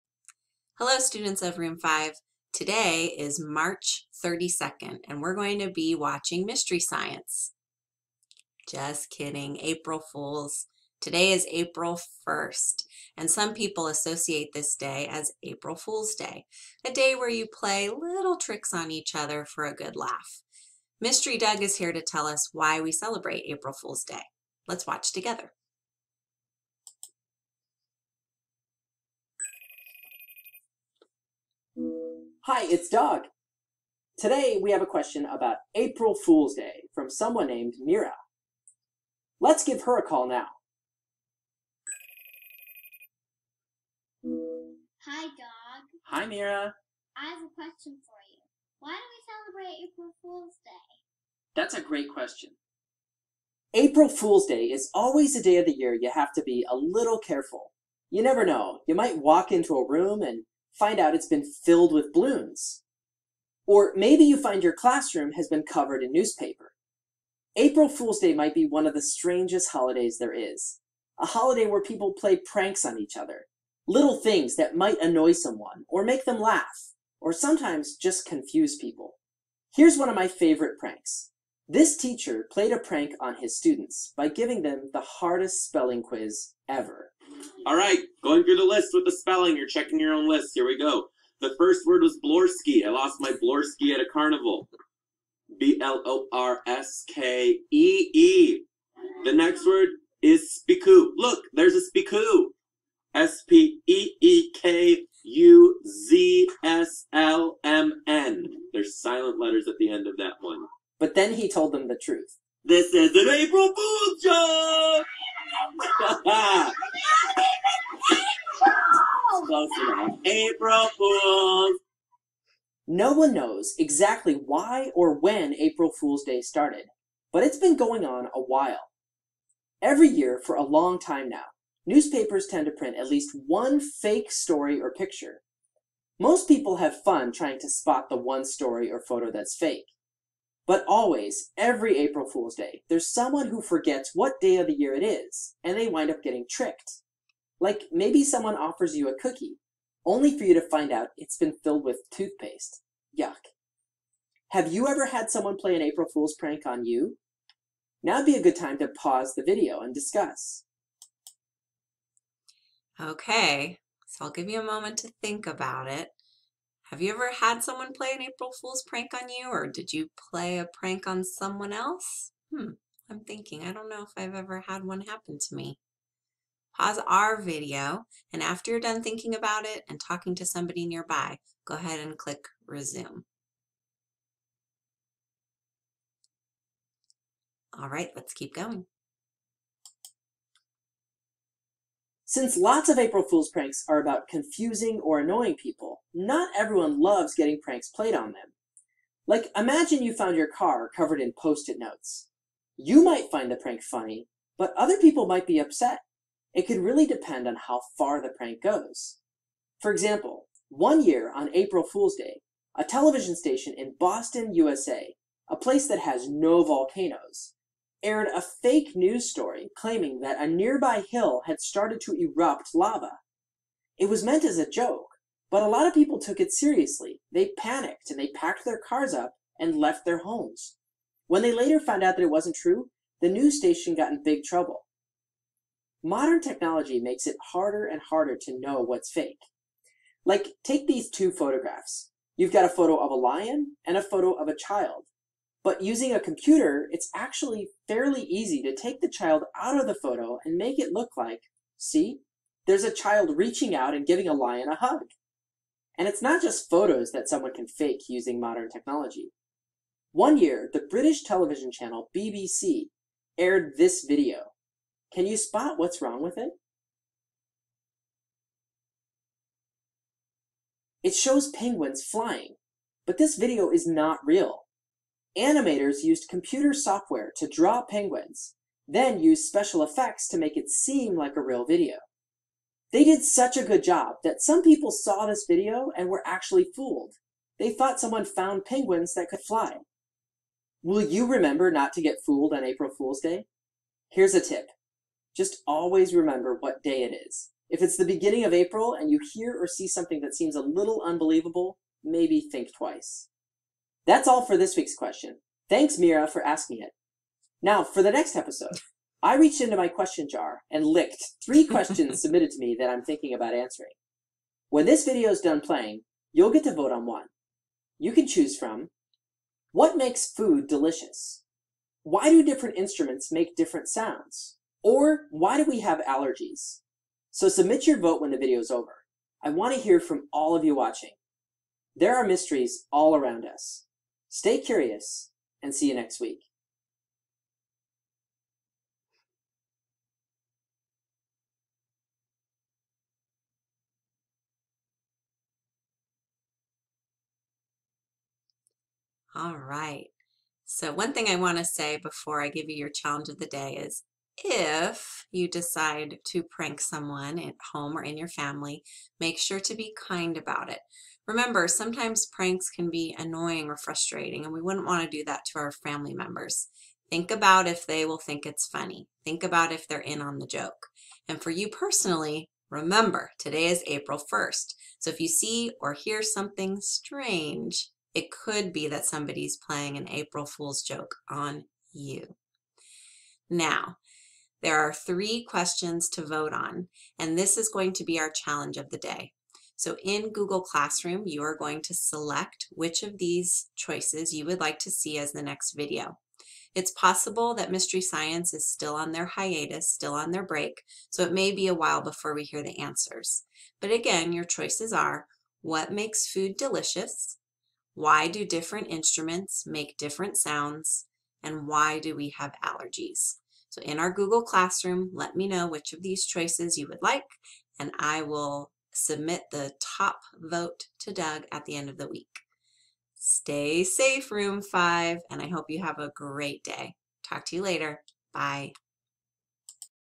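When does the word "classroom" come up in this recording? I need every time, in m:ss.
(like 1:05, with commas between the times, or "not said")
1:04, 6:30, 6:54.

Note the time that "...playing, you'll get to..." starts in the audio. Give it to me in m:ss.
5:15.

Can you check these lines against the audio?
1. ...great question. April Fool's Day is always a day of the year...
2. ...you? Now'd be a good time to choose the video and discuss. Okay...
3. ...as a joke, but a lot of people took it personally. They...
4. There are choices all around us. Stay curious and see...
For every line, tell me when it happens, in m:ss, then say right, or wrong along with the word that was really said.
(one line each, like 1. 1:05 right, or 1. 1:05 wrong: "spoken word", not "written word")
1. 0:51 right
2. 2:36 wrong: "pause", not "choose"
3. 3:44 wrong: "seriously", not "personally"
4. 5:31 wrong: "mysteries", not "choices".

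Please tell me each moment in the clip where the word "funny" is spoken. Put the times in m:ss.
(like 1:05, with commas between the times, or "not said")
3:23, 6:08.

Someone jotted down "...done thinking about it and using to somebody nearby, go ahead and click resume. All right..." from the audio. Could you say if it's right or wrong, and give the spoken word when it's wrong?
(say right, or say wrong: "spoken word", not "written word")
wrong: "talking", not "using".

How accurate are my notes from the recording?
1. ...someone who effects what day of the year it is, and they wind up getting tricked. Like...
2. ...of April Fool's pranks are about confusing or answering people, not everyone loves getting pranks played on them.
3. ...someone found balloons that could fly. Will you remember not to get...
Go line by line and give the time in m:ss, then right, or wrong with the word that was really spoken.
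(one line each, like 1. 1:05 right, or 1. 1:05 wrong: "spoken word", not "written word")
1. 2:23 wrong: "forgets", not "effects"
2. 3:12 wrong: "annoying", not "answering"
3. 4:48 wrong: "penguins", not "balloons".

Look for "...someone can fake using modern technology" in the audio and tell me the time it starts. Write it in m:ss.
4:17.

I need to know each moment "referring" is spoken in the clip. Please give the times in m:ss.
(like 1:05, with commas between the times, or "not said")
not said.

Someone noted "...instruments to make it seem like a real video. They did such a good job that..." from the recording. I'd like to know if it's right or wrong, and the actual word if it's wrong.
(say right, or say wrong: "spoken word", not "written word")
wrong: "effects", not "instruments".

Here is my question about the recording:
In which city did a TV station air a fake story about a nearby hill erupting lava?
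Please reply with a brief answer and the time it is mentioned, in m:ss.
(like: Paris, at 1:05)
Boston, at 3:33.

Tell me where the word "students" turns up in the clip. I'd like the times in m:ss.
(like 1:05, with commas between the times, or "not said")
0:00, 1:23.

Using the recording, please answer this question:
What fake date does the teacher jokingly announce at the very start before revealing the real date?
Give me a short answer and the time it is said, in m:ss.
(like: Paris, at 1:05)
March 32nd, at 0:03.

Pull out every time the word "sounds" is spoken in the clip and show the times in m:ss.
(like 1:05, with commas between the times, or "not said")
5:23, 6:50.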